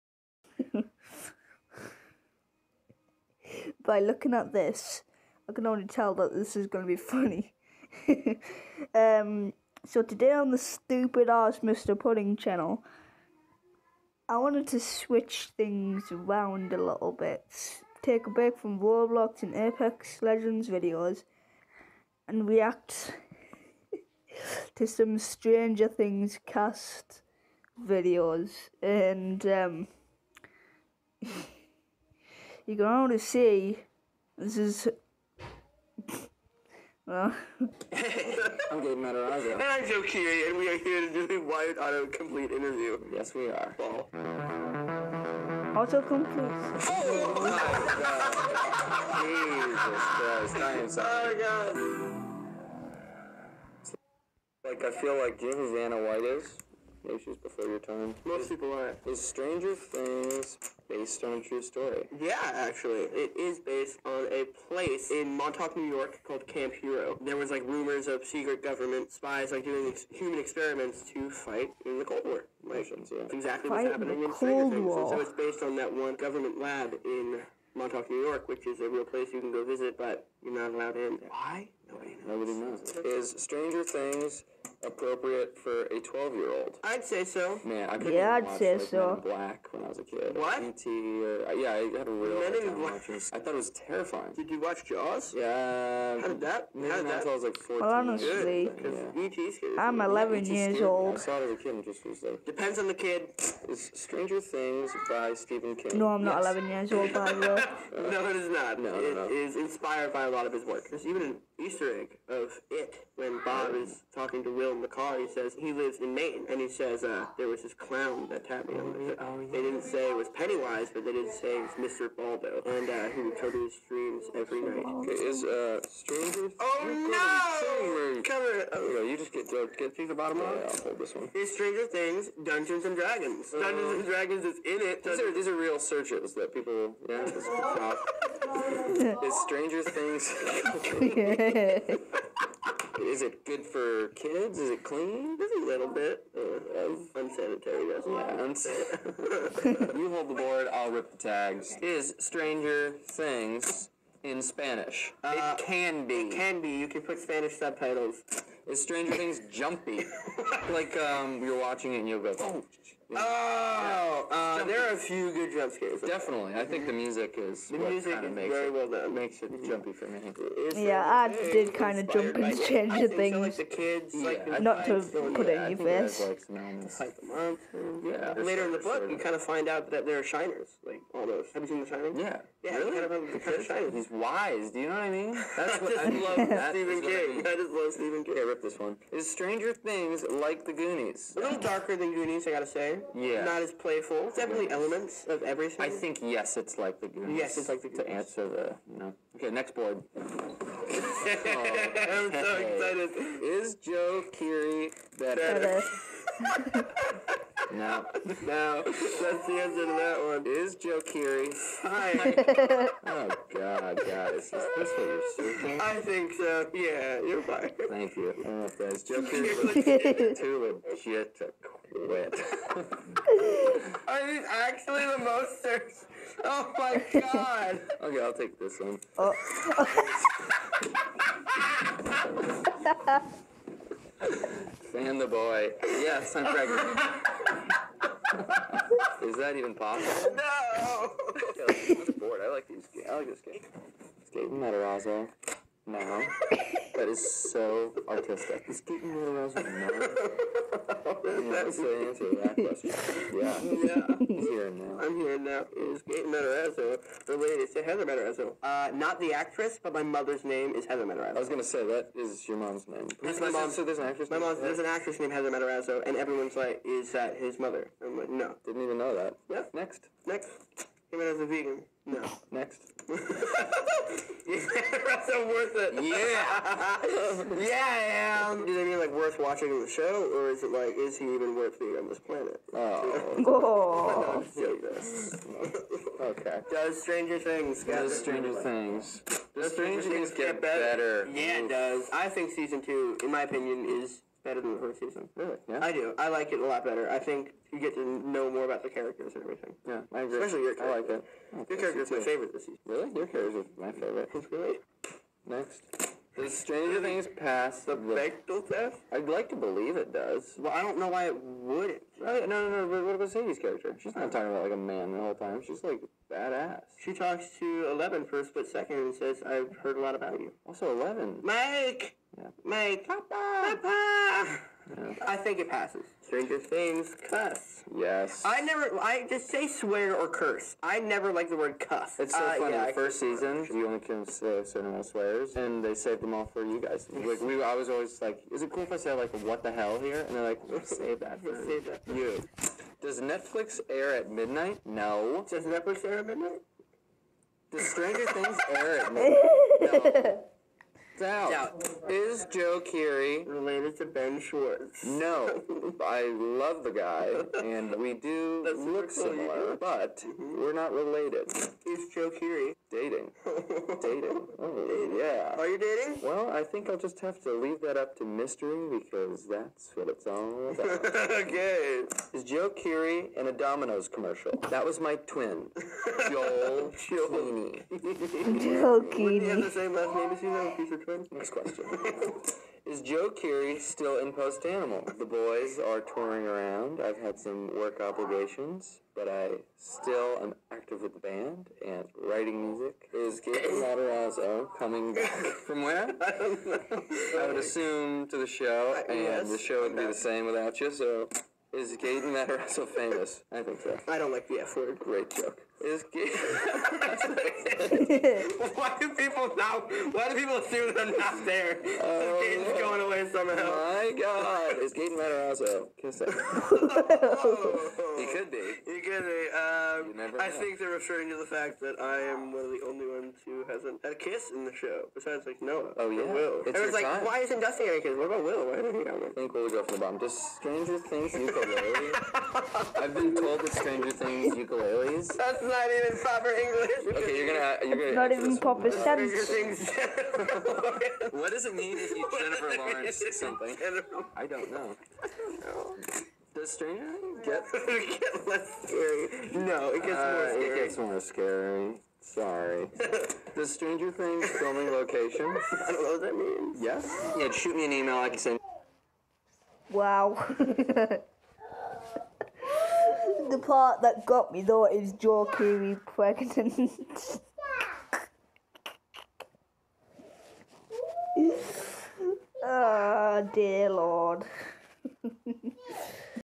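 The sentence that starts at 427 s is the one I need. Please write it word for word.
why isn't Dustin having a kiss?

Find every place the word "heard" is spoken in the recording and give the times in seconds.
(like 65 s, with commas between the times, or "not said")
319 s.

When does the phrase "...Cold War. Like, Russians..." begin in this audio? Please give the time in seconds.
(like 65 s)
72 s.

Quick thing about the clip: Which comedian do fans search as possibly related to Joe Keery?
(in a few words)
Ben Schwartz.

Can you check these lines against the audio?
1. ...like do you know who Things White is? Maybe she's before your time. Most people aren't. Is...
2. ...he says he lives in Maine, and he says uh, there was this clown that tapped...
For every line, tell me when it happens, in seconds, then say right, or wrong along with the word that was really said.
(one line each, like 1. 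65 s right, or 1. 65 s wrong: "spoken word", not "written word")
1. 55 s wrong: "Vanna", not "Things"
2. 115 s right.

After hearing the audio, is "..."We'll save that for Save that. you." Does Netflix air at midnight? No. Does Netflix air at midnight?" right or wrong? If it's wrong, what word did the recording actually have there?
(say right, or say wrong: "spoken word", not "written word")
right.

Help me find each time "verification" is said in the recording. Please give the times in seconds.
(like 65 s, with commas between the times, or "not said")
not said.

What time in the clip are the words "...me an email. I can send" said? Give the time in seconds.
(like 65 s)
457 s.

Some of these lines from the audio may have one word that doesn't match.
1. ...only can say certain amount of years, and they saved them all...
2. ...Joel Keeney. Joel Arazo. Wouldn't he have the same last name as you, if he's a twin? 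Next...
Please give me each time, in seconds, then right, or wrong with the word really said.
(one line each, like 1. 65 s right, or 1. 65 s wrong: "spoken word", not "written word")
1. 333 s wrong: "swears", not "years"
2. 377 s wrong: "Keeney", not "Arazo".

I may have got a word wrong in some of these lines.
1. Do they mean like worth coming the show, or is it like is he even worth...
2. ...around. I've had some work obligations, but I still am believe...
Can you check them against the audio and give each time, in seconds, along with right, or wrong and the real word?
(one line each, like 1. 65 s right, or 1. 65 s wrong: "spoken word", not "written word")
1. 278 s wrong: "watching", not "coming"
2. 386 s wrong: "active", not "believe".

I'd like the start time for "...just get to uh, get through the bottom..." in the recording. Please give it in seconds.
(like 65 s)
129 s.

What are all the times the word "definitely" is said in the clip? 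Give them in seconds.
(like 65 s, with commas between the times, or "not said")
166 s, 194 s.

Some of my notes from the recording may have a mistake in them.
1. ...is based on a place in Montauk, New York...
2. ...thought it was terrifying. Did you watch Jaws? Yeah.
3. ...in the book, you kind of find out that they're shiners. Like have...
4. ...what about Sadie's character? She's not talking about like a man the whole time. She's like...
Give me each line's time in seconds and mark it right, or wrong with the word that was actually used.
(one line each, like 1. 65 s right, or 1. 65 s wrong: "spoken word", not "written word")
1. 63 s right
2. 93 s right
3. 178 s right
4. 313 s right.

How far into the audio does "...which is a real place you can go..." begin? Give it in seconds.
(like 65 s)
78 s.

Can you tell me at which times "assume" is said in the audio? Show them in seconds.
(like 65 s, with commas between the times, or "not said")
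397 s, 410 s.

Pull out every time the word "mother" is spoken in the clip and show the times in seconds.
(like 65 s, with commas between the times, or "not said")
260 s, 267 s.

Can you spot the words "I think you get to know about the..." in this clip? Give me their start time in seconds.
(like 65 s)
297 s.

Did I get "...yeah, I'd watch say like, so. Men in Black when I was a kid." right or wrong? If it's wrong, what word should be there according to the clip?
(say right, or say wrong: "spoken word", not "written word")
right.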